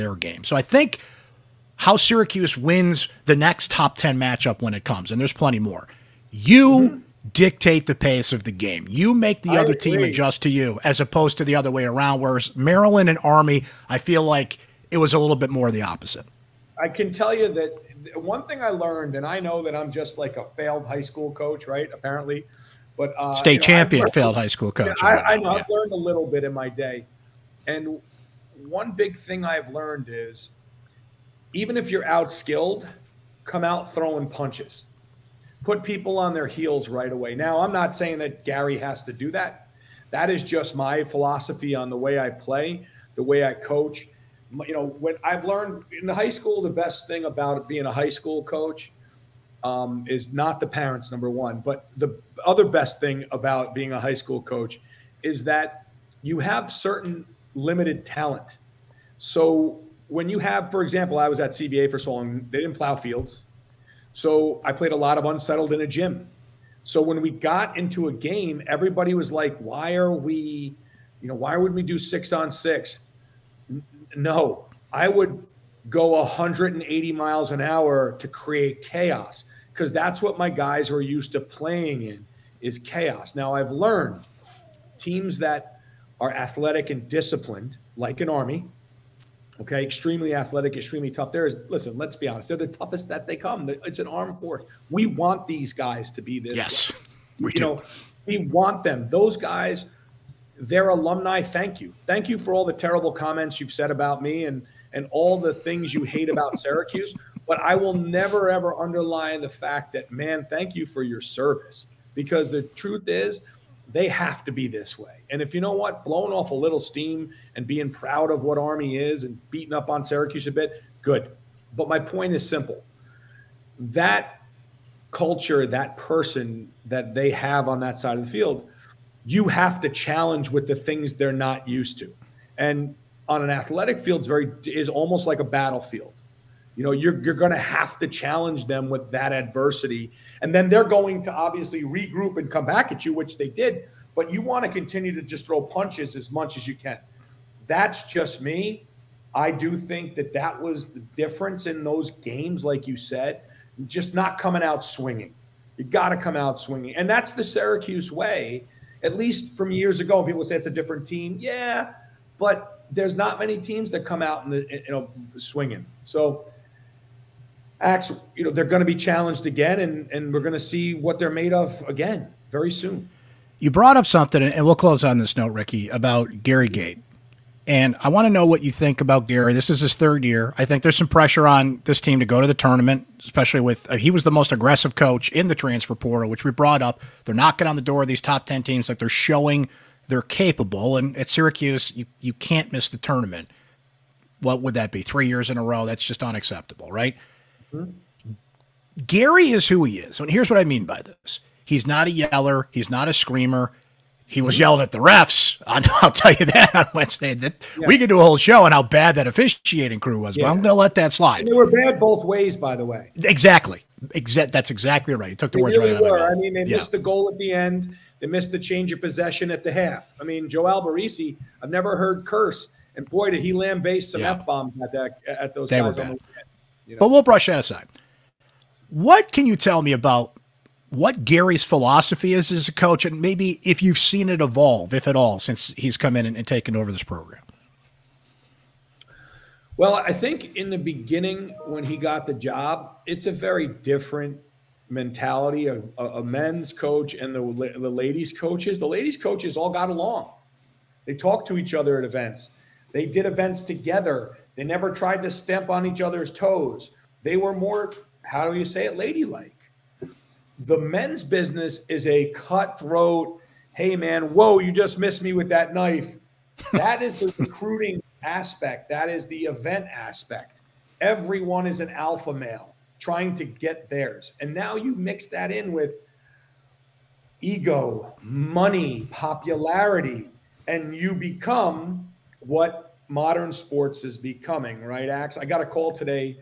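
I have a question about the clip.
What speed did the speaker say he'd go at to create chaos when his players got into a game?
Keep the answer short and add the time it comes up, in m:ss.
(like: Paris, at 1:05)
180 miles an hour, at 1:16.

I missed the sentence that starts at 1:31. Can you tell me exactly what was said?
There is listen, let's be honest, they're the toughest that they come.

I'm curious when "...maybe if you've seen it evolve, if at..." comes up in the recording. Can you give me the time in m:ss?
3:53.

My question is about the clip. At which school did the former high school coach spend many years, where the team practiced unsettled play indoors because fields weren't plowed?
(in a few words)
CBA.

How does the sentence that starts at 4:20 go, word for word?
The men's business is a cutthroat, hey man, whoa, you just missed me with that knife.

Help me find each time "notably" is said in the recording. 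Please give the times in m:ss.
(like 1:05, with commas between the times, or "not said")
not said.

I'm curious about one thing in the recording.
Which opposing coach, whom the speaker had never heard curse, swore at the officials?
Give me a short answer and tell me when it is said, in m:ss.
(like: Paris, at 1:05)
Joe Alberici, at 3:40.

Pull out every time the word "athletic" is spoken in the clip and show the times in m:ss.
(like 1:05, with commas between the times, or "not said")
1:26, 1:30, 2:13.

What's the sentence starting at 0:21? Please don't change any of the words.
Apparently, but uh, state know, champion learned, failed high school coach.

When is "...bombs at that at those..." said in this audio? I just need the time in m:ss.
3:44.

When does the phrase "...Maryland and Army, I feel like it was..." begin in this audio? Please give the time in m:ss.
0:12.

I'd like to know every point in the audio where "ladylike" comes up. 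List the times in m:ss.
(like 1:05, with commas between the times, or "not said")
4:18.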